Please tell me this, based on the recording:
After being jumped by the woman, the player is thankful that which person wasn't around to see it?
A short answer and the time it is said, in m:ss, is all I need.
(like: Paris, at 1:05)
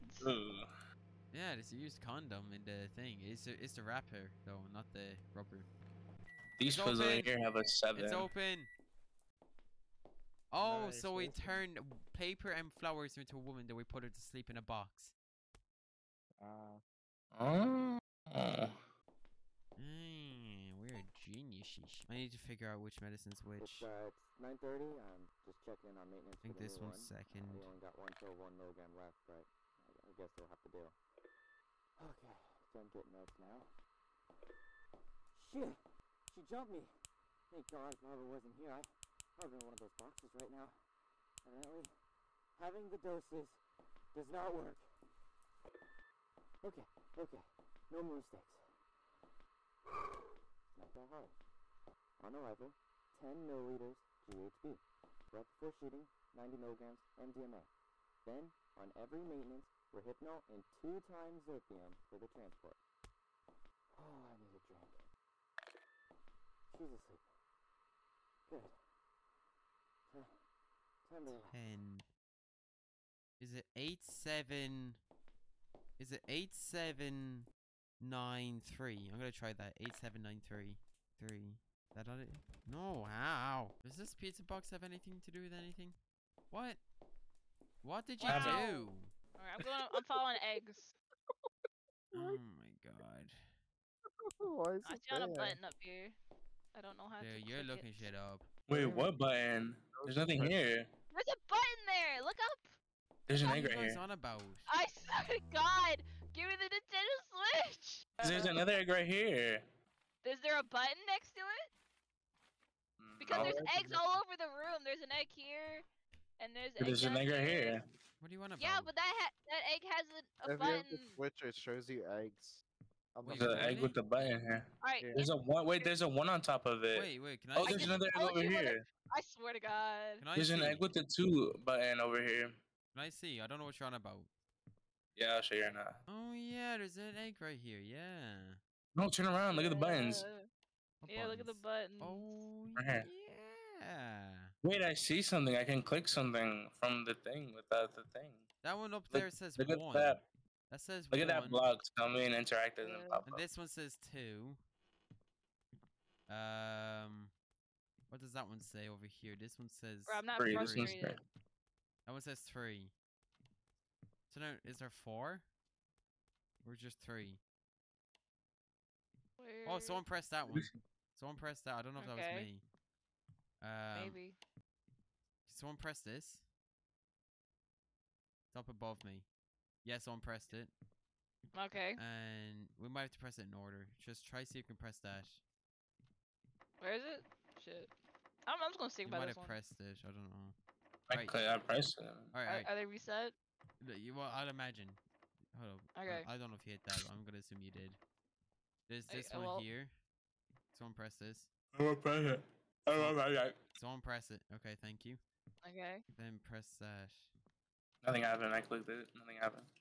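Barbara, at 0:37.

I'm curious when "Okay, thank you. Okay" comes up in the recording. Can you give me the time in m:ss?
3:24.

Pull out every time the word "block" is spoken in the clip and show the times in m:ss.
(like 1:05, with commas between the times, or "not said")
2:31.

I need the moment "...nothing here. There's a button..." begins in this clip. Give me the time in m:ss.
1:40.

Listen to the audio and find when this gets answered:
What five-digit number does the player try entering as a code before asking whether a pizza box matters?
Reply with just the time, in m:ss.
1:19.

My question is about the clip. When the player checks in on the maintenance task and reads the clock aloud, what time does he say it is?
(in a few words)
9:30.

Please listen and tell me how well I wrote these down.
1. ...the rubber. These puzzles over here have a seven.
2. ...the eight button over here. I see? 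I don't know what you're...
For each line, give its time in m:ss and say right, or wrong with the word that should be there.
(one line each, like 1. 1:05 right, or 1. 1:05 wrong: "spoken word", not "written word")
1. 0:04 right
2. 2:10 wrong: "two", not "eight".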